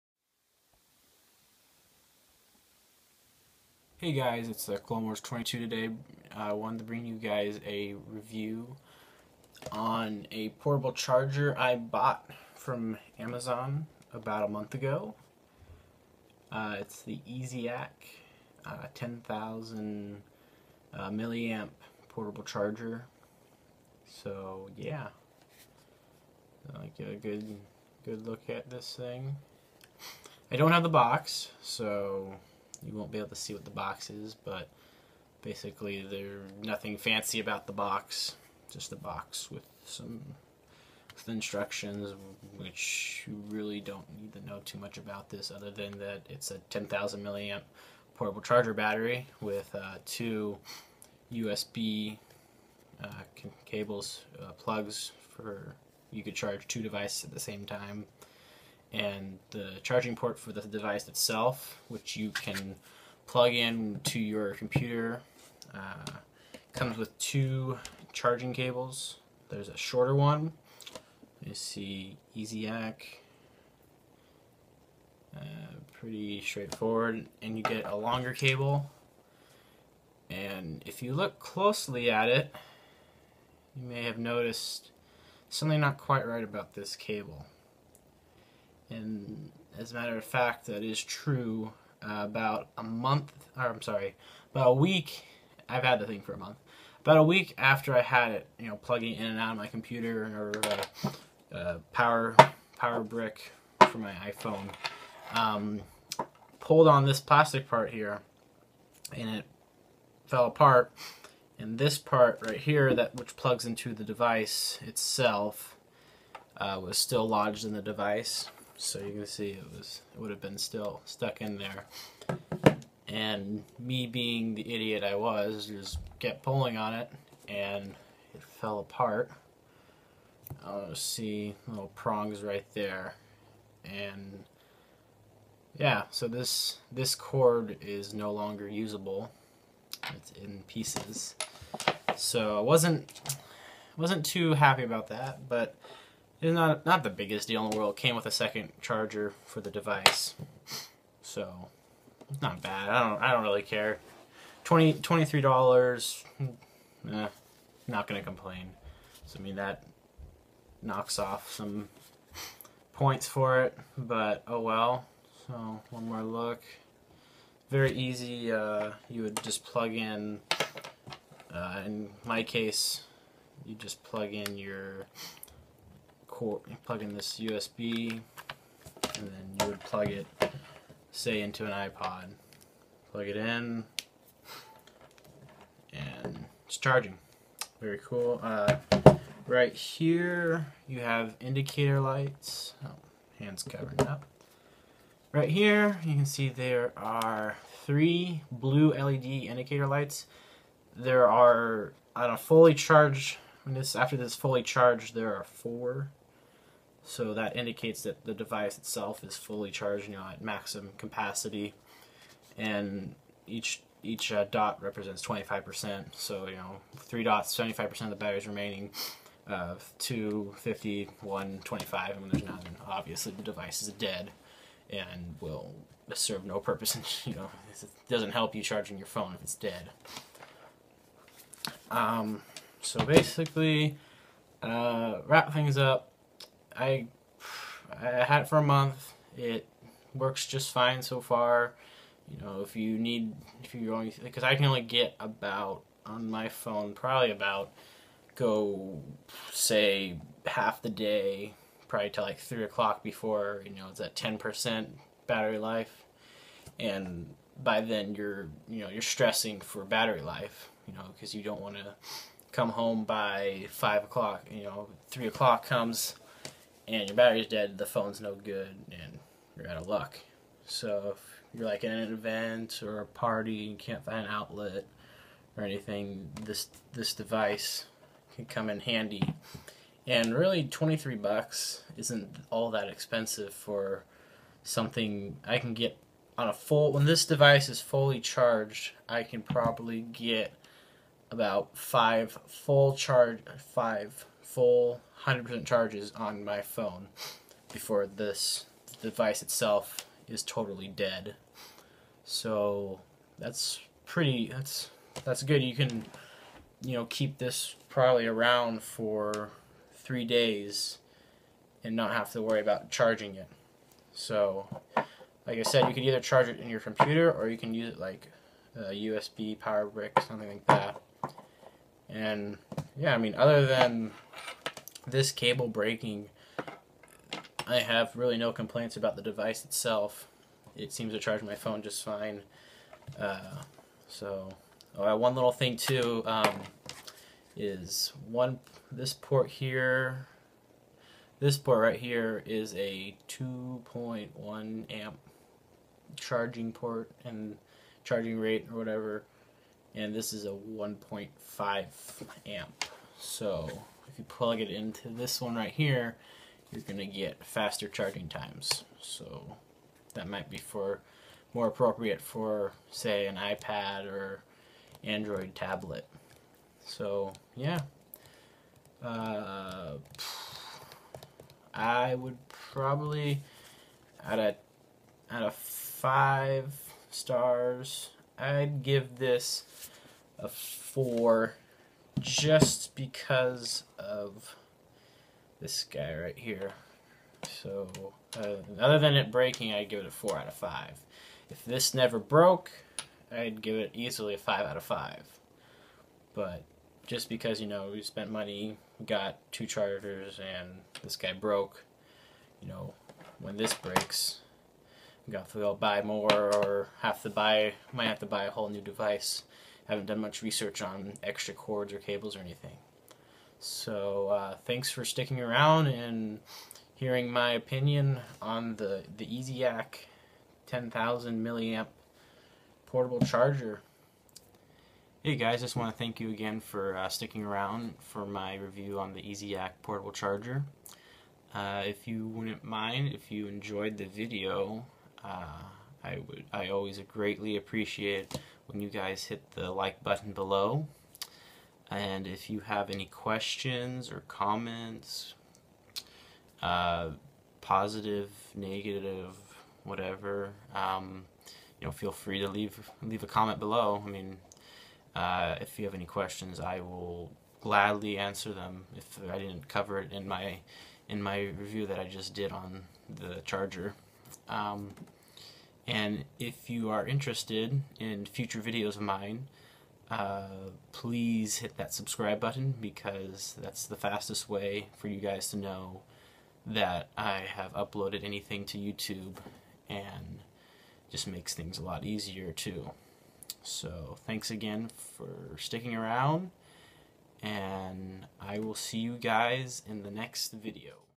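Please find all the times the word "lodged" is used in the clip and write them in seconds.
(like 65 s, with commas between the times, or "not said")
117 s.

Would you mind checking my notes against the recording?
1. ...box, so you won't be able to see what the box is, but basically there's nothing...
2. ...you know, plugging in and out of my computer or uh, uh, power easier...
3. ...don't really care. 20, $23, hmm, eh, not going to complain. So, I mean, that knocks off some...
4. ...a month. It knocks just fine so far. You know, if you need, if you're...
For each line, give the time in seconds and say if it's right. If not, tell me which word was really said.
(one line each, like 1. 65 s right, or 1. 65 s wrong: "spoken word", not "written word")
1. 30 s right
2. 98 s wrong: "power", not "easier"
3. 153 s right
4. 238 s wrong: "works", not "knocks".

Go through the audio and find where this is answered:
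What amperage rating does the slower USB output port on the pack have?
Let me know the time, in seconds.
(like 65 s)
350 s.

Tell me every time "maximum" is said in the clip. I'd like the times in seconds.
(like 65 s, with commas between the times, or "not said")
210 s.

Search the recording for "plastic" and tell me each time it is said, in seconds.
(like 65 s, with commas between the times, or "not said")
107 s.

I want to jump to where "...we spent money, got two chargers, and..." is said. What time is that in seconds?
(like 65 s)
397 s.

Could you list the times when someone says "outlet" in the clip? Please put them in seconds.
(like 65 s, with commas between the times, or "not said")
274 s.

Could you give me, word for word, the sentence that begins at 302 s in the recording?
So that's pretty that's that's good.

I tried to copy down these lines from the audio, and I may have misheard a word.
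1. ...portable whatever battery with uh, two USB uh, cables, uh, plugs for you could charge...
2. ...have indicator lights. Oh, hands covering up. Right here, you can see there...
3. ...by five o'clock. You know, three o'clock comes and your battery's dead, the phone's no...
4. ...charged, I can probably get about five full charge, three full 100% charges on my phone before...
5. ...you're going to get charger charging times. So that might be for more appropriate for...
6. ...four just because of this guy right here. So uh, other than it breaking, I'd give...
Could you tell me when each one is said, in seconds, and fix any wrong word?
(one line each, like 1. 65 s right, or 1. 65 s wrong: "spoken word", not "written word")
1. 48 s wrong: "charger", not "whatever"
2. 191 s right
3. 263 s right
4. 288 s wrong: "five", not "three"
5. 356 s wrong: "faster", not "charger"
6. 380 s right.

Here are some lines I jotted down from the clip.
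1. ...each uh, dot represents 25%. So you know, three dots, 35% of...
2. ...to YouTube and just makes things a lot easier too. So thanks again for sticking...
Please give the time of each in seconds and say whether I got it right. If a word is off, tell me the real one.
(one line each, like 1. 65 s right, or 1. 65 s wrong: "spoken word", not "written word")
1. 214 s wrong: "75", not "35"
2. 478 s right.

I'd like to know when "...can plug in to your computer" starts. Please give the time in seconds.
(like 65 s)
62 s.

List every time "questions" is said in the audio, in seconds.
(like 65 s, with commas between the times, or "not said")
443 s, 456 s.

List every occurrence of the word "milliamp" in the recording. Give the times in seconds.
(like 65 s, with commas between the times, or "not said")
21 s, 47 s, 421 s.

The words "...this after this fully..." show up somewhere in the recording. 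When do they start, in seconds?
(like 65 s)
203 s.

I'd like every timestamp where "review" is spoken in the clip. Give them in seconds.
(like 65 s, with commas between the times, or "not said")
8 s, 428 s, 461 s.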